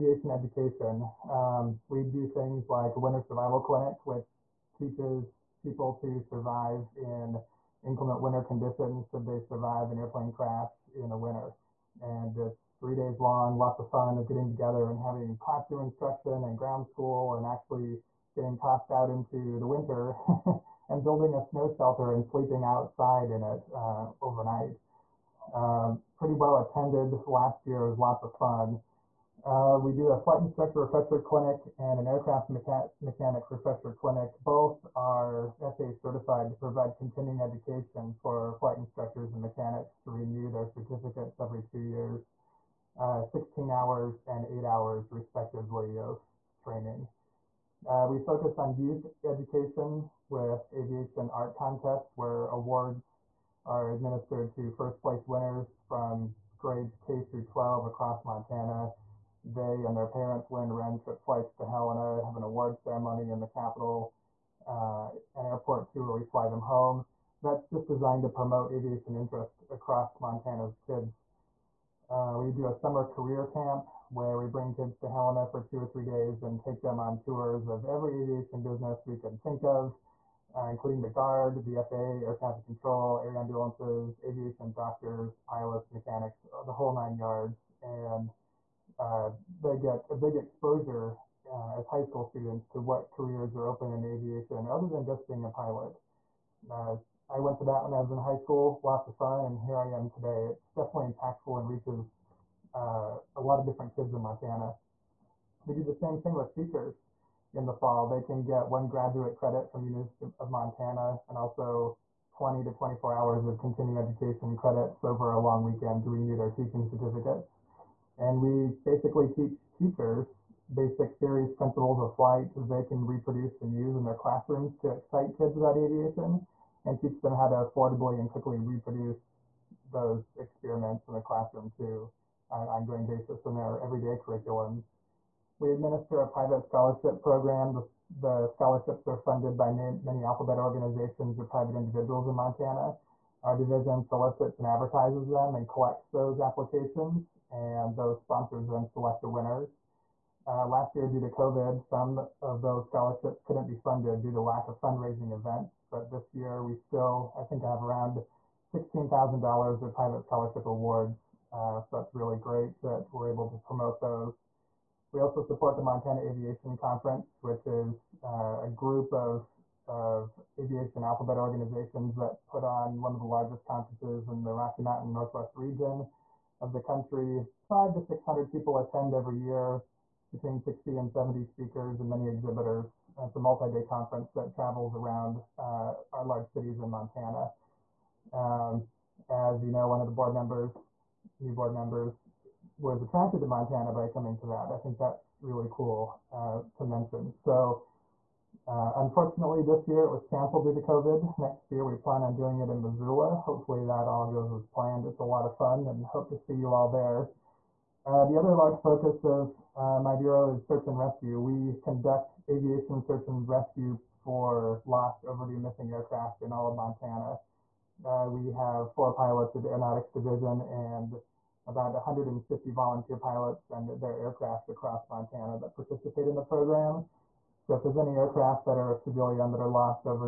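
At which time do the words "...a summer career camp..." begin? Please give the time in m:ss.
1:12.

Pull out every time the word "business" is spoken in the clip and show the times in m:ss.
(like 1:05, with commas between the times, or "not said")
1:18.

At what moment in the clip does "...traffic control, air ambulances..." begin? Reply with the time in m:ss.
1:22.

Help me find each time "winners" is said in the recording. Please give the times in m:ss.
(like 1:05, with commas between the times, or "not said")
0:55, 2:29.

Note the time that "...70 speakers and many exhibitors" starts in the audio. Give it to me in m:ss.
3:01.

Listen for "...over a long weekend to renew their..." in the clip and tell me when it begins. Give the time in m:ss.
1:55.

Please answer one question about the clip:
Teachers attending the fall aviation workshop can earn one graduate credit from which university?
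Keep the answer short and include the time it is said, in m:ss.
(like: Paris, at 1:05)
University of Montana, at 1:49.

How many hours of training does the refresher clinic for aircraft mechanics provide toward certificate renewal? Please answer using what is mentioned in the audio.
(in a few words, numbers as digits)
8 hours.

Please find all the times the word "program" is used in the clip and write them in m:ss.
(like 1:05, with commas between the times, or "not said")
2:17, 3:46.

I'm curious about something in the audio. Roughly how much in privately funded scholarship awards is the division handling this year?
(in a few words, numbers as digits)
$16,000.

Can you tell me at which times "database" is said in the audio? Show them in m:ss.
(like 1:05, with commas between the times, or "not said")
not said.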